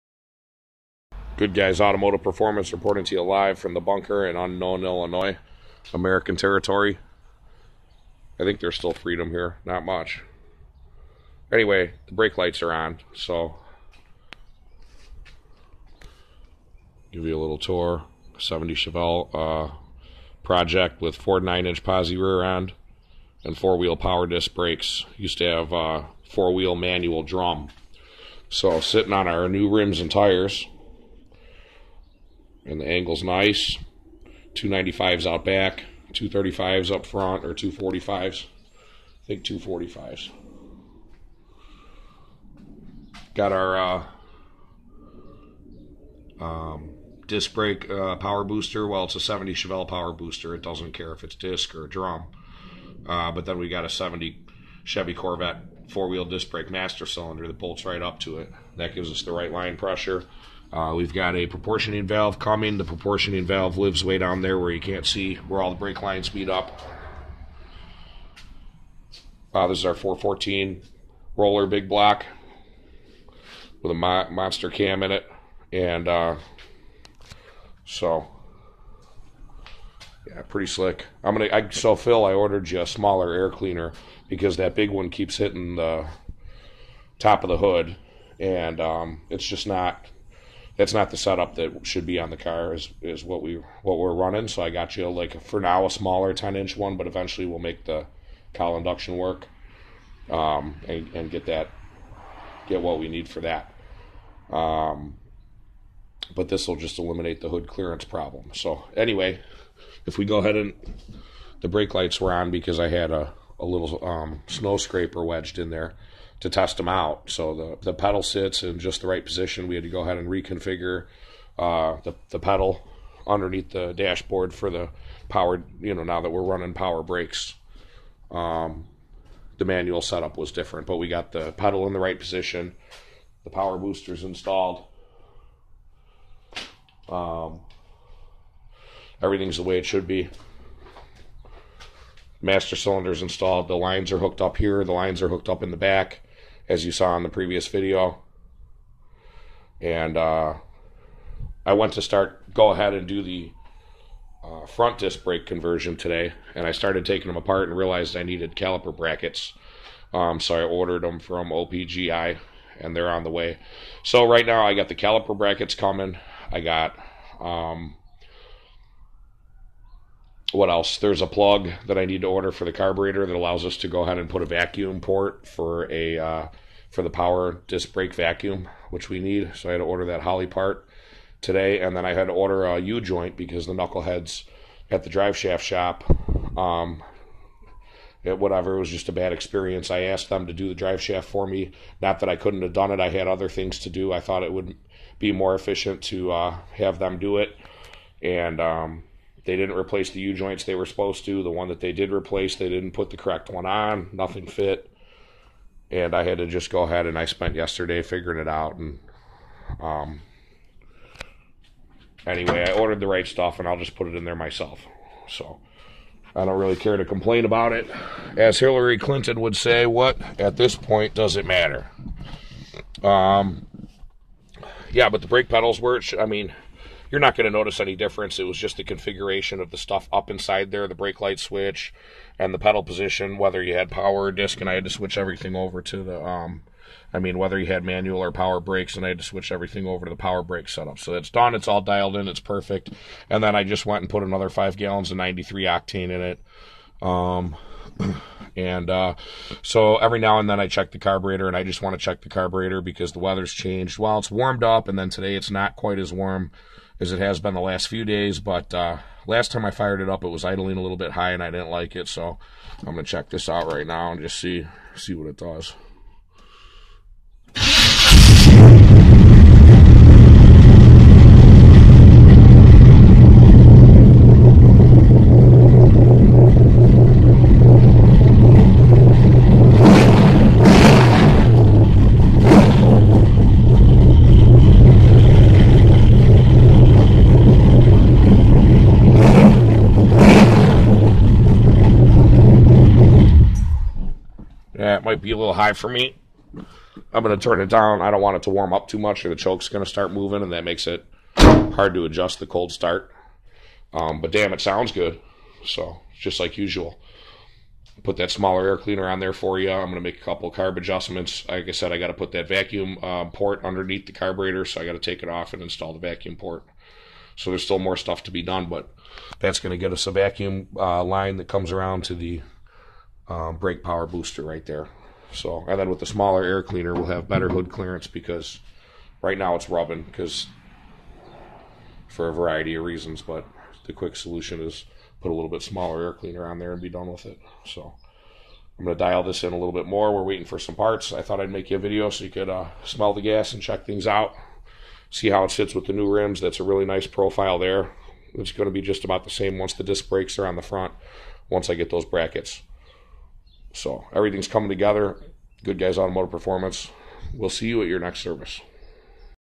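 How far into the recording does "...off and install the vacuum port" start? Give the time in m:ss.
5:15.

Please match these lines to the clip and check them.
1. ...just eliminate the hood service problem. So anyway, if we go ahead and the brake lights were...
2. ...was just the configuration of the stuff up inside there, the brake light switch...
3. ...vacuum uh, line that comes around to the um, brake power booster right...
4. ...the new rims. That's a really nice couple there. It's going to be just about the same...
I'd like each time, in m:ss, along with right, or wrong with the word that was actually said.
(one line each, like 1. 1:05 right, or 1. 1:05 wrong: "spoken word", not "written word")
1. 1:46 wrong: "clearance", not "service"
2. 3:48 right
3. 5:20 right
4. 5:45 wrong: "profile", not "couple".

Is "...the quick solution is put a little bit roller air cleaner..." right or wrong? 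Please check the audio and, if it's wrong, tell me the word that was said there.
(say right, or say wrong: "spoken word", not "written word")
wrong: "smaller", not "roller".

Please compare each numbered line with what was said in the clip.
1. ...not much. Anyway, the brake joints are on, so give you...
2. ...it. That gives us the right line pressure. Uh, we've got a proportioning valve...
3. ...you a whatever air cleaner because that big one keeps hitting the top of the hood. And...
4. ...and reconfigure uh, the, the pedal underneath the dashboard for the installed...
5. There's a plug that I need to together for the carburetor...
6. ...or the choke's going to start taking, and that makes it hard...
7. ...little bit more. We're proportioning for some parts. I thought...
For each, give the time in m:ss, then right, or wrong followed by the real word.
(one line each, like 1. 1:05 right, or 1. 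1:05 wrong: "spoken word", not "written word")
1. 0:09 wrong: "lights", not "joints"
2. 0:58 right
3. 1:22 wrong: "smaller", not "whatever"
4. 2:00 wrong: "powered", not "installed"
5. 2:50 wrong: "order", not "together"
6. 4:59 wrong: "moving", not "taking"
7. 5:39 wrong: "waiting", not "proportioning".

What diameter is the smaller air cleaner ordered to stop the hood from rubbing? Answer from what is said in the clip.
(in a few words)
10 inch.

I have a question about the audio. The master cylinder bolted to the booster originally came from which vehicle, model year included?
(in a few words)
70 Chevy Corvette.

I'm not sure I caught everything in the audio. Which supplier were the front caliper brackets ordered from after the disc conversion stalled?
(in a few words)
OPGI.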